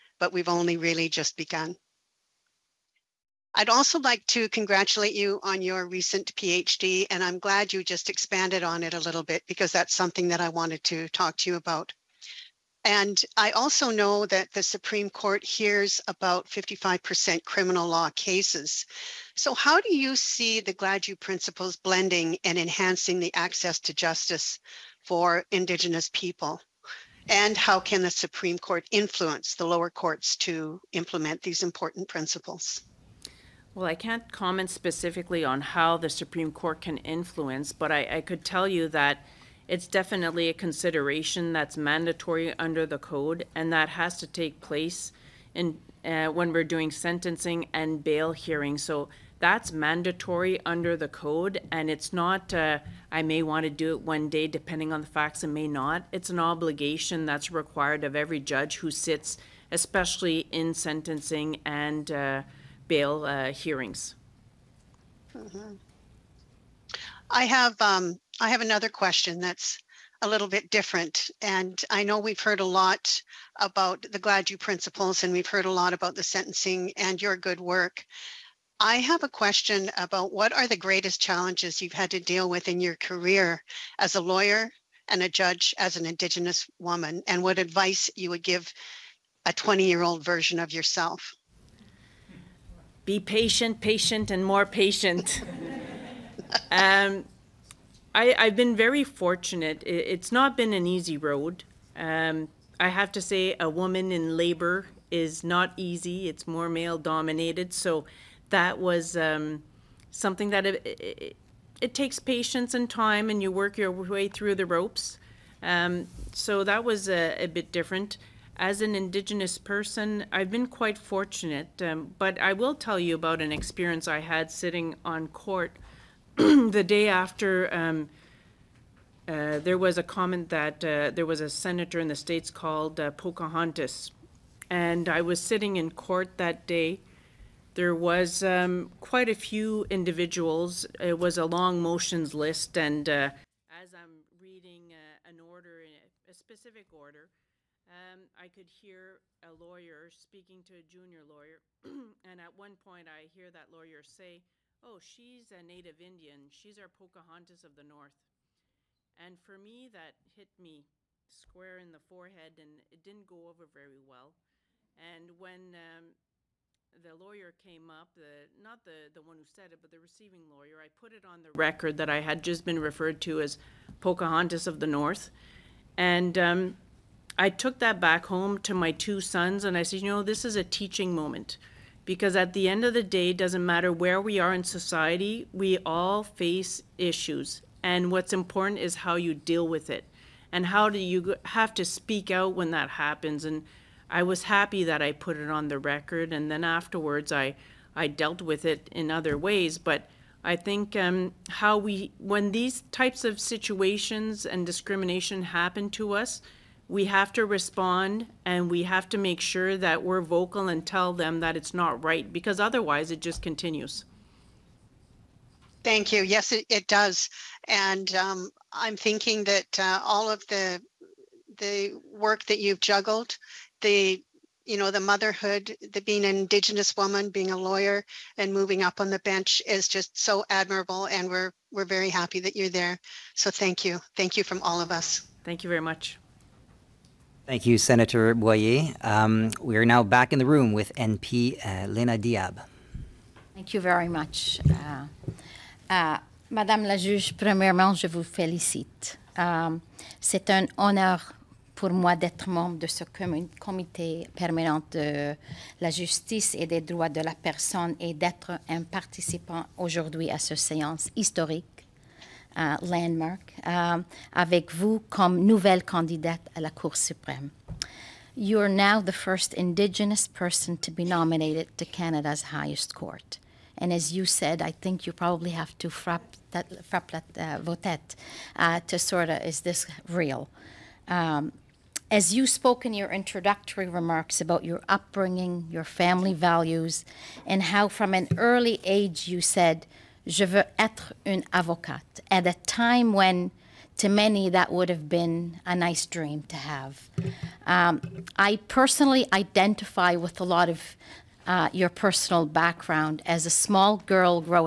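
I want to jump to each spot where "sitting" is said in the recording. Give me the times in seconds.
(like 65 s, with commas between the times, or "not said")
124 s, 135 s.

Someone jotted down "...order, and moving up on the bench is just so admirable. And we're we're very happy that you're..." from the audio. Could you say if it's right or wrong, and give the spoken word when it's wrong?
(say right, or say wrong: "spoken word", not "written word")
wrong: "lawyer", not "order".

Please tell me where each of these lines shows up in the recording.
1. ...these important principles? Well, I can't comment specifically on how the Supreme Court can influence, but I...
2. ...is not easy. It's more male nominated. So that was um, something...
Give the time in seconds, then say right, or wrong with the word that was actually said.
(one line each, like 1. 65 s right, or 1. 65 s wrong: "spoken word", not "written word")
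1. 31 s right
2. 105 s wrong: "dominated", not "nominated".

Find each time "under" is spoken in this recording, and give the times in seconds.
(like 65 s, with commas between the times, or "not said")
42 s, 50 s.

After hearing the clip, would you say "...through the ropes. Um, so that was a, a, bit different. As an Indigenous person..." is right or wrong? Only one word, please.
right.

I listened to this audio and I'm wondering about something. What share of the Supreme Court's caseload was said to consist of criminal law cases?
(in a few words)
55%.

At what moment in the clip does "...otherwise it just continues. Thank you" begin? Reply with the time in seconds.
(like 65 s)
212 s.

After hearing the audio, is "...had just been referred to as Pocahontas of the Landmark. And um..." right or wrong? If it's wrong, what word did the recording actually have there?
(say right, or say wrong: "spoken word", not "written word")
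wrong: "North", not "Landmark".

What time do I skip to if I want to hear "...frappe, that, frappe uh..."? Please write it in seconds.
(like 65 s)
275 s.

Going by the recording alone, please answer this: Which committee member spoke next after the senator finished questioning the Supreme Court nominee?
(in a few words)
Lena Diab.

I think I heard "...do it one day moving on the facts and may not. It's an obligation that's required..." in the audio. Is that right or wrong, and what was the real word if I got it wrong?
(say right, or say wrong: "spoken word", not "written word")
wrong: "depending", not "moving".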